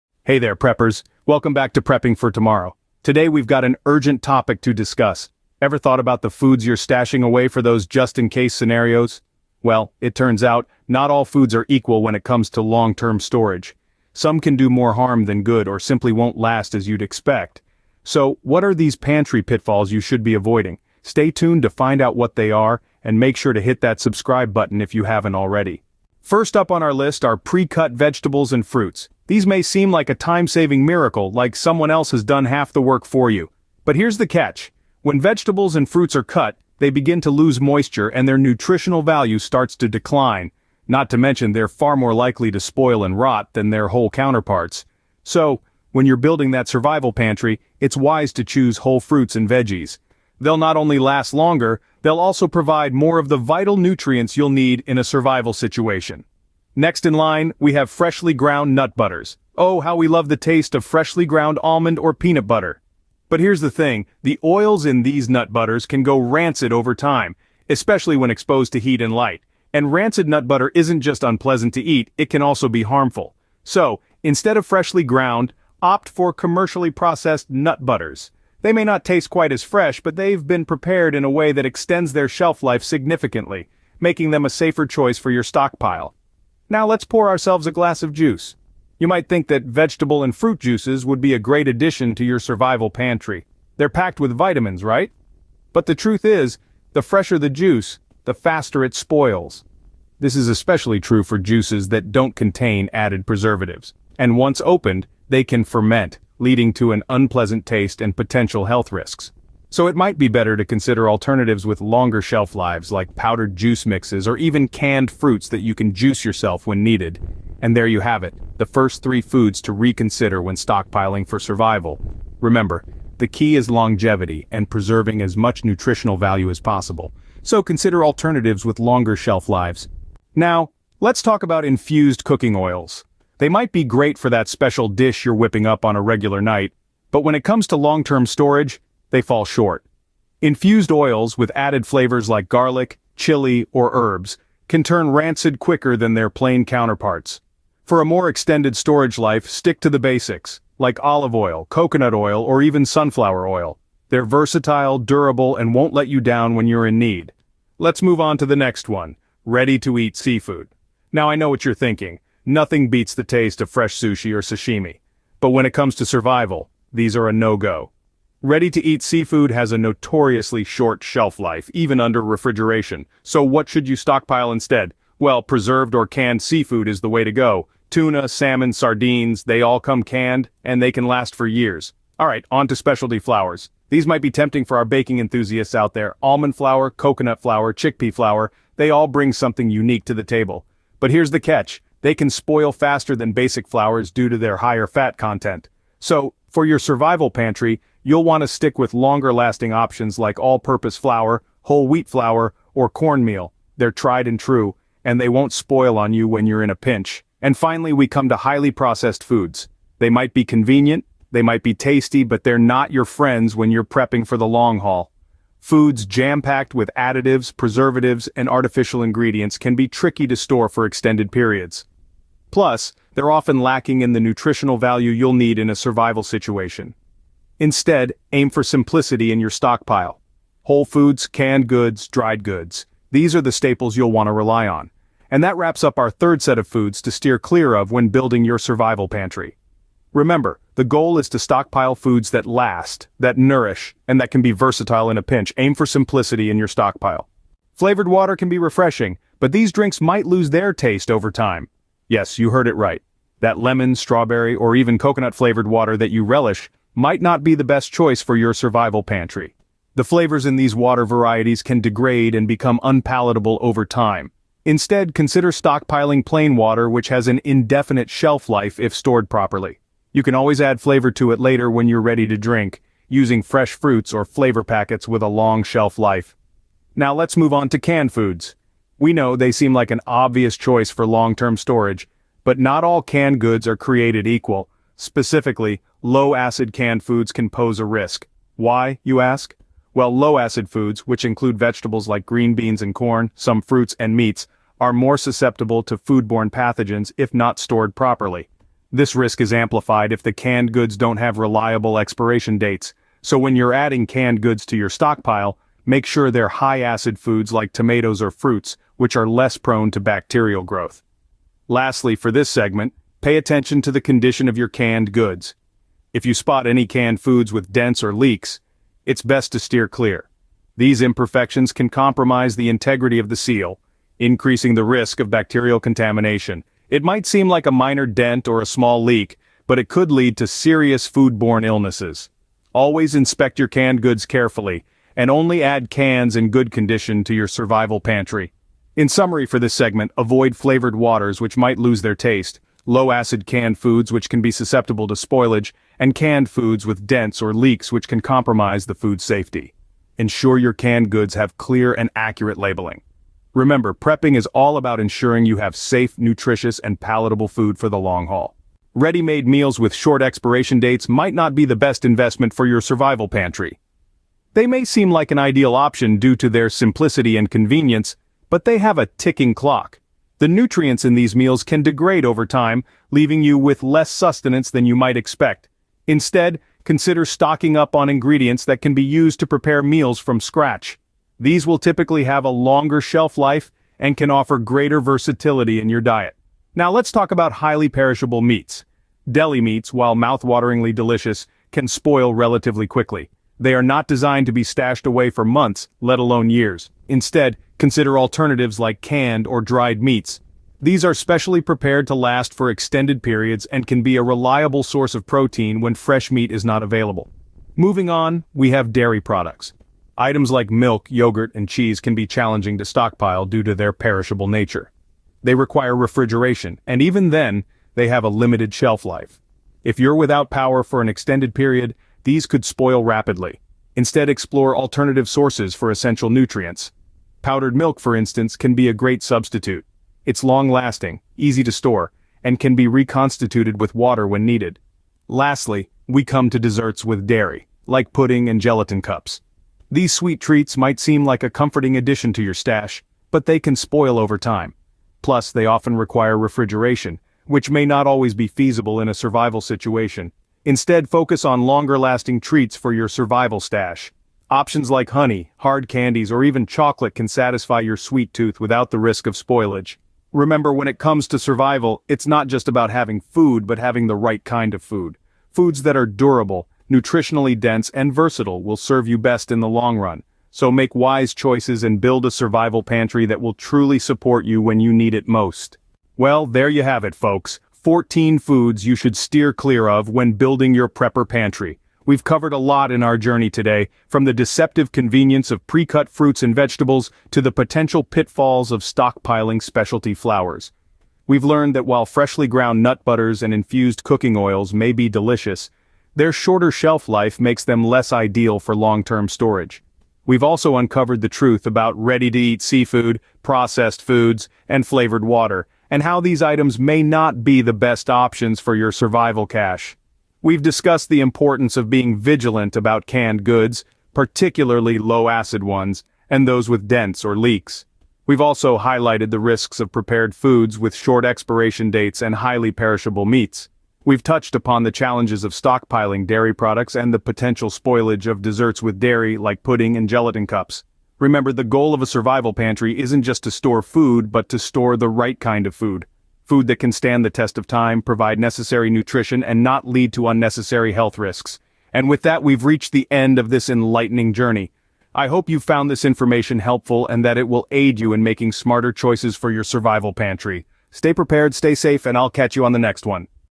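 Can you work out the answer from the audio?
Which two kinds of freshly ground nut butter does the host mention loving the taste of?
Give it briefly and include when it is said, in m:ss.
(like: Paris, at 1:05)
Almond or peanut, at 1:01.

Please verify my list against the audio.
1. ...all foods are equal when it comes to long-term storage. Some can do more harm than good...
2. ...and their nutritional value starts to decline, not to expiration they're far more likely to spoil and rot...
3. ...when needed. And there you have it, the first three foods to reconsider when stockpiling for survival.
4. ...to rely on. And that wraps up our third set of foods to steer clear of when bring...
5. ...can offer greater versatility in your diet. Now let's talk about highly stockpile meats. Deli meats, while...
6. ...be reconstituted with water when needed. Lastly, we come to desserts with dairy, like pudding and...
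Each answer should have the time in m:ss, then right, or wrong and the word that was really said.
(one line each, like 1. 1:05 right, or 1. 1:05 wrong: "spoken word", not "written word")
1. 0:11 right
2. 0:38 wrong: "mention", not "expiration"
3. 1:56 right
4. 3:54 wrong: "building", not "bring"
5. 6:24 wrong: "perishable", not "stockpile"
6. 7:12 right.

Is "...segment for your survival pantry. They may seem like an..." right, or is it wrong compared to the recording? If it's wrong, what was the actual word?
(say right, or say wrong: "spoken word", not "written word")
wrong: "investment", not "segment".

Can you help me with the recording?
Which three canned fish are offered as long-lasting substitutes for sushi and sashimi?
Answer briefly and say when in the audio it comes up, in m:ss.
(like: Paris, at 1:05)
Tuna, salmon, sardines, at 2:57.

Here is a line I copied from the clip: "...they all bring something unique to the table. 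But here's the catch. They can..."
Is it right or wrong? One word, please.
right.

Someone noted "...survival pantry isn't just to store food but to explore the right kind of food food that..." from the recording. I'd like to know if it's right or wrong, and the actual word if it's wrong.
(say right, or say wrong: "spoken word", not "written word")
wrong: "store", not "explore".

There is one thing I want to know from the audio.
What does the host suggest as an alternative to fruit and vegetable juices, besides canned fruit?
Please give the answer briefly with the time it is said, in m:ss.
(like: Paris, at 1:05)
Powdered juice mixes, at 1:53.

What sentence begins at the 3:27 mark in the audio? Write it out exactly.
And finally, we come to highly processed foods.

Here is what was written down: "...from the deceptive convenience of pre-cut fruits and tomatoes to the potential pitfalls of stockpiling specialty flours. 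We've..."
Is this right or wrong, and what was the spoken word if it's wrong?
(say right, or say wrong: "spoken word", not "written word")
wrong: "vegetables", not "tomatoes".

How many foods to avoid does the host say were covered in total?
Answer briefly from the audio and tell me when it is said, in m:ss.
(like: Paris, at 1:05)
14, at 7:57.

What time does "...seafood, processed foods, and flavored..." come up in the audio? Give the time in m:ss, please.
8:22.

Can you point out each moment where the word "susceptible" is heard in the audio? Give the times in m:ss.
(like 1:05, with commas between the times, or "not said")
4:55, 5:44.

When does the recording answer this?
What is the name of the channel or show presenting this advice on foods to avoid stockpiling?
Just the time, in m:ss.
0:01.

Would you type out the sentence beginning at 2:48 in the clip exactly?
Ready-to-eat seafood has a notoriously short shelf life, even under refrigeration, so what should you stockpile instead?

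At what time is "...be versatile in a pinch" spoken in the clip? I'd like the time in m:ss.
4:04.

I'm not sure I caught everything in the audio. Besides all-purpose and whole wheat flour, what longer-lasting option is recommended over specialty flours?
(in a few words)
Cornmeal.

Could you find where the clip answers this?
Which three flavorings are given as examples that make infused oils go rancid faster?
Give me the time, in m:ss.
2:22.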